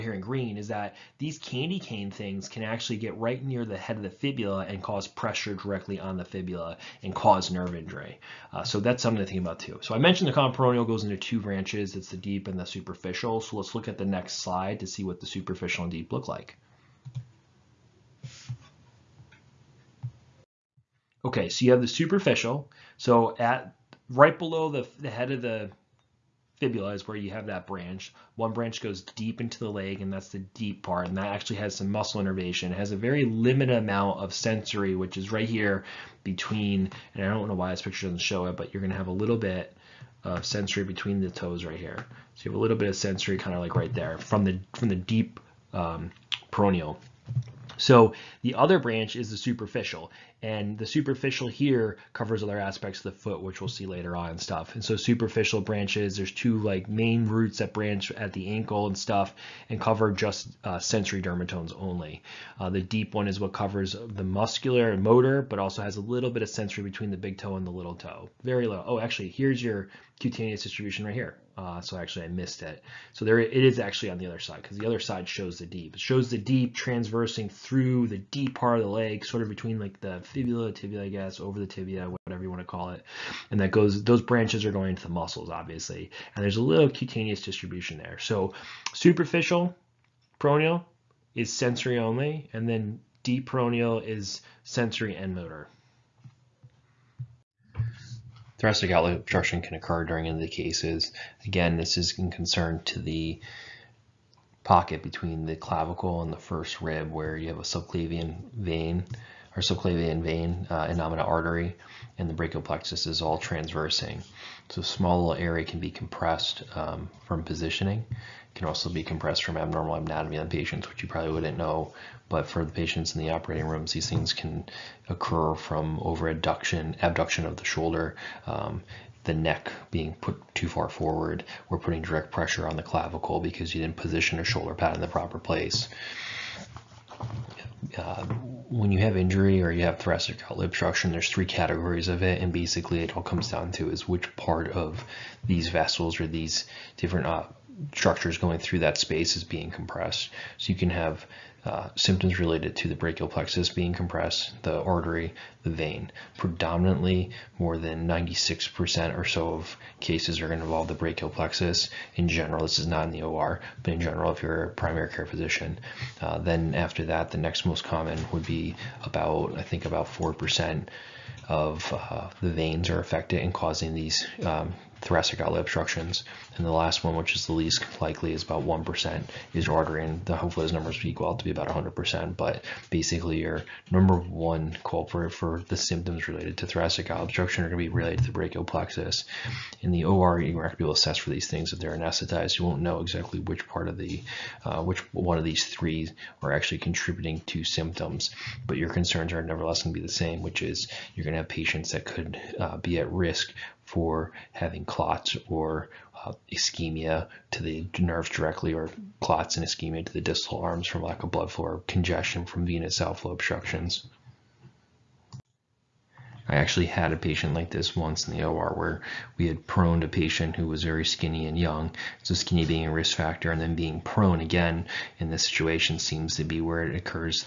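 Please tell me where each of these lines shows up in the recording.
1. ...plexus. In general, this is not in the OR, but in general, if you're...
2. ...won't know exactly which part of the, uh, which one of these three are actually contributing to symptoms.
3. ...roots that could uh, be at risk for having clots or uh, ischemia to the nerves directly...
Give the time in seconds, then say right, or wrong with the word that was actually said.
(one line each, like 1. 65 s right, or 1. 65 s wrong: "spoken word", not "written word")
1. 161 s right
2. 192 s right
3. 201 s wrong: "patients", not "roots".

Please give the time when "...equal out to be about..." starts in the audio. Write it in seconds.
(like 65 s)
181 s.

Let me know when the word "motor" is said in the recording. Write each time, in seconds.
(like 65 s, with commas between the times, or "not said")
65 s, 95 s.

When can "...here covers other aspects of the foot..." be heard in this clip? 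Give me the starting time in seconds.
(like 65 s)
51 s.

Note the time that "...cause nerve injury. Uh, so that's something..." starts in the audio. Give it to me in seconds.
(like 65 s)
7 s.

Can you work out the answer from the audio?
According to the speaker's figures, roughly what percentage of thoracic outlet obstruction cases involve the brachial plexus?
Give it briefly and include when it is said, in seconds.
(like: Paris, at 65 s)
96%, at 158 s.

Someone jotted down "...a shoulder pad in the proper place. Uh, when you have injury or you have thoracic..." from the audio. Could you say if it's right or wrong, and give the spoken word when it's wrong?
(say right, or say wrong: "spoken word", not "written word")
right.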